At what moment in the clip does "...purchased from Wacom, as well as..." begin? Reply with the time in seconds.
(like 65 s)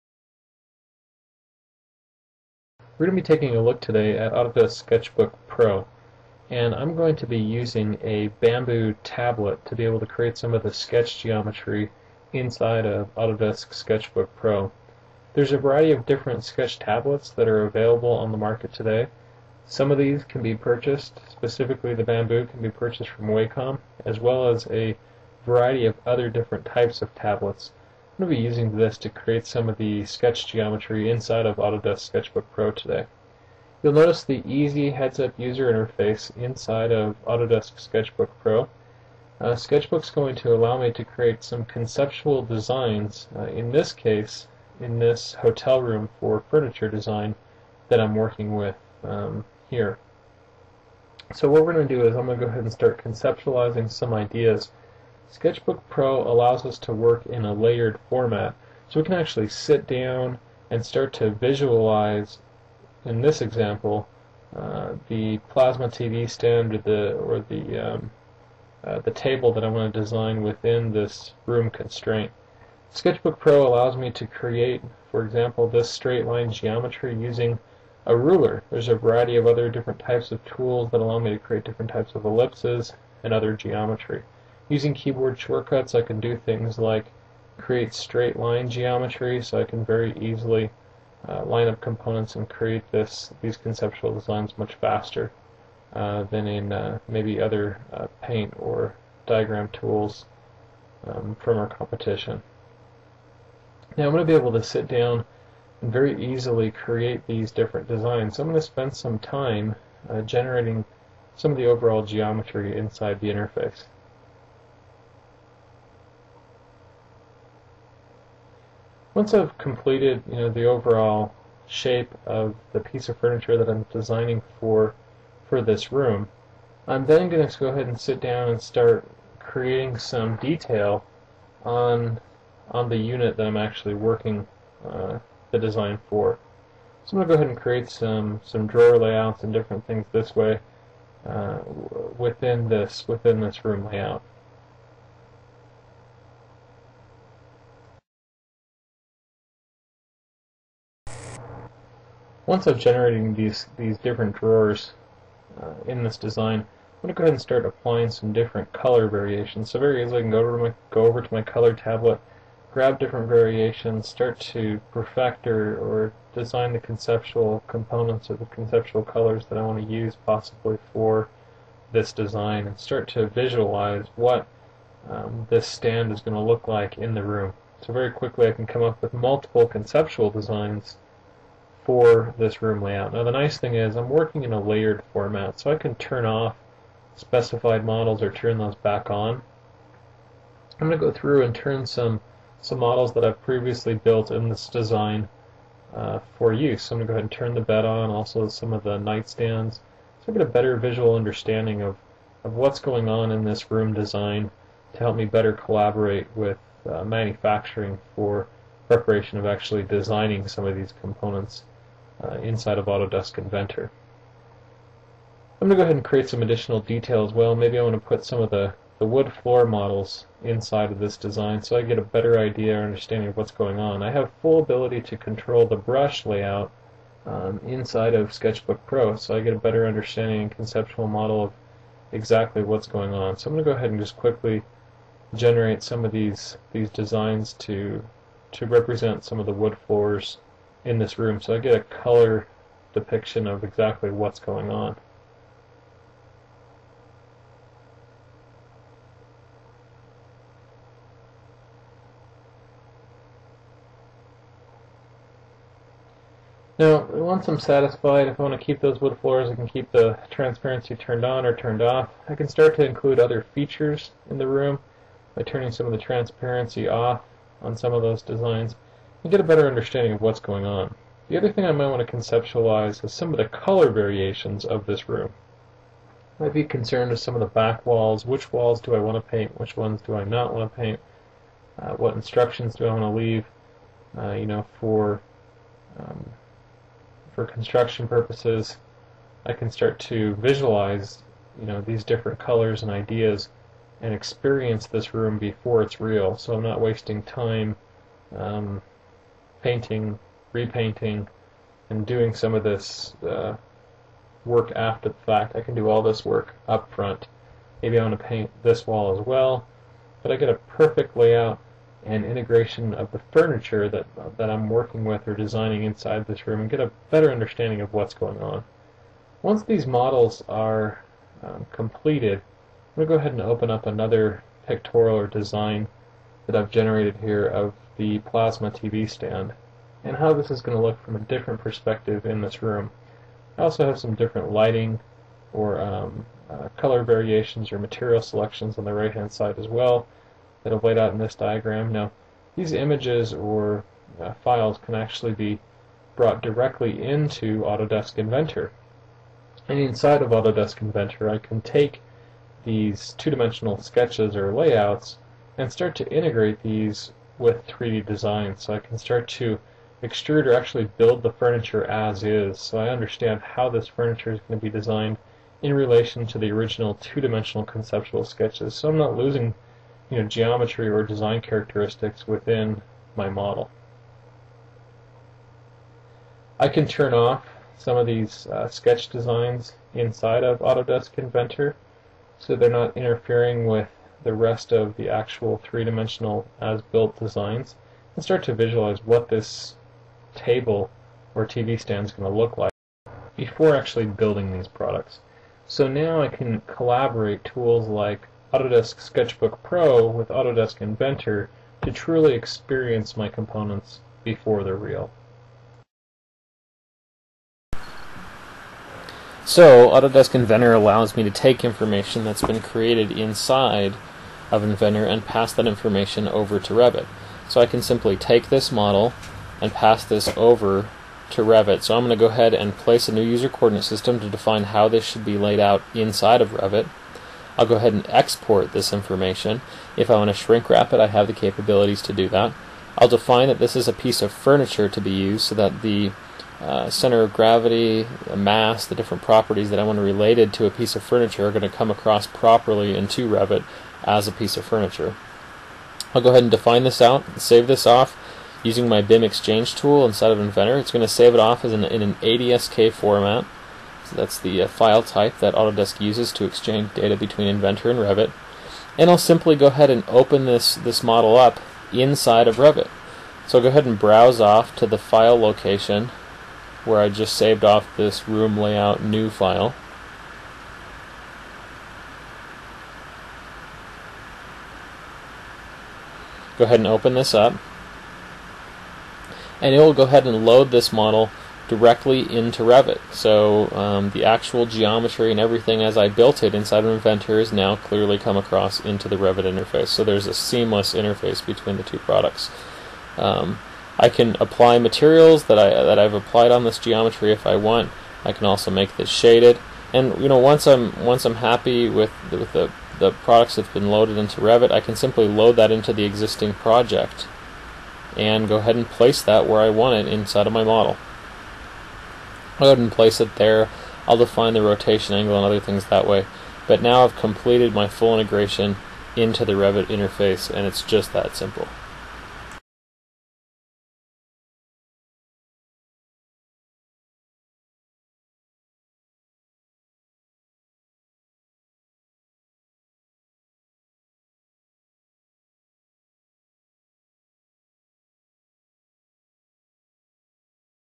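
22 s.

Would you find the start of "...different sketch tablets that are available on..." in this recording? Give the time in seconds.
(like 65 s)
16 s.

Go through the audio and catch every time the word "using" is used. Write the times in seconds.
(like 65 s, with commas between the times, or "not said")
7 s, 28 s, 77 s, 84 s, 448 s.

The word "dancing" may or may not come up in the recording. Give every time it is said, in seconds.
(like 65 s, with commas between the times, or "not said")
not said.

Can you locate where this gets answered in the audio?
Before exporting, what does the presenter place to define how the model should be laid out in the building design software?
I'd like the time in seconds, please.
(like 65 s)
423 s.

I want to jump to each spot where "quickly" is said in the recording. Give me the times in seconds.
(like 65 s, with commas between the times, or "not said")
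178 s, 234 s.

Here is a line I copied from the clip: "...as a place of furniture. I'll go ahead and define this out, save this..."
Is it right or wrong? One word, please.
wrong.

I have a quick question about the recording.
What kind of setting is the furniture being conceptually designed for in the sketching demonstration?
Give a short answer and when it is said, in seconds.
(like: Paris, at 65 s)
Hotel room, at 45 s.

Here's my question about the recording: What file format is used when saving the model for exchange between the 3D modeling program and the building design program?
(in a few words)
ADSK.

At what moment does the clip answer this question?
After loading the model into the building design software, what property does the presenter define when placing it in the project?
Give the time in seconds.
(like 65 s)
514 s.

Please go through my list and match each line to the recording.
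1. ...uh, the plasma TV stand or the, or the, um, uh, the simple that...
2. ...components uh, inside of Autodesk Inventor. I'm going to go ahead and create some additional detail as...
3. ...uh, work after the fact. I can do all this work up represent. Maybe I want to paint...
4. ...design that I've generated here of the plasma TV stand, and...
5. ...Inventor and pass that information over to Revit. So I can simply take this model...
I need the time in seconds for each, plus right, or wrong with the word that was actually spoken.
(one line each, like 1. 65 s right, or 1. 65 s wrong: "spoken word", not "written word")
1. 64 s wrong: "table", not "simple"
2. 211 s right
3. 303 s wrong: "front", not "represent"
4. 325 s right
5. 414 s right.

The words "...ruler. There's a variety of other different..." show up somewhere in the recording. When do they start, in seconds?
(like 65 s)
78 s.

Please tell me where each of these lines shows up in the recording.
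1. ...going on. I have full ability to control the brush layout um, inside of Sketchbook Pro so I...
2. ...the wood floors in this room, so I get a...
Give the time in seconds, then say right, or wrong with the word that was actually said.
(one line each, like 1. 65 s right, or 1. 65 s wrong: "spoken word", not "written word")
1. 223 s right
2. 239 s right.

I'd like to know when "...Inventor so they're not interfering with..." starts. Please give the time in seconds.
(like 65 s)
381 s.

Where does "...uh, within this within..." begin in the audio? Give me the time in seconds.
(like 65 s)
141 s.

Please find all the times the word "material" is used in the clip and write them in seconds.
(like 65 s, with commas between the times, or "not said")
337 s, 494 s.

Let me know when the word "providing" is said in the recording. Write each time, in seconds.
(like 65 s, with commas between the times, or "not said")
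not said.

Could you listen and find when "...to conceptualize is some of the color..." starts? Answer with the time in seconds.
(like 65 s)
272 s.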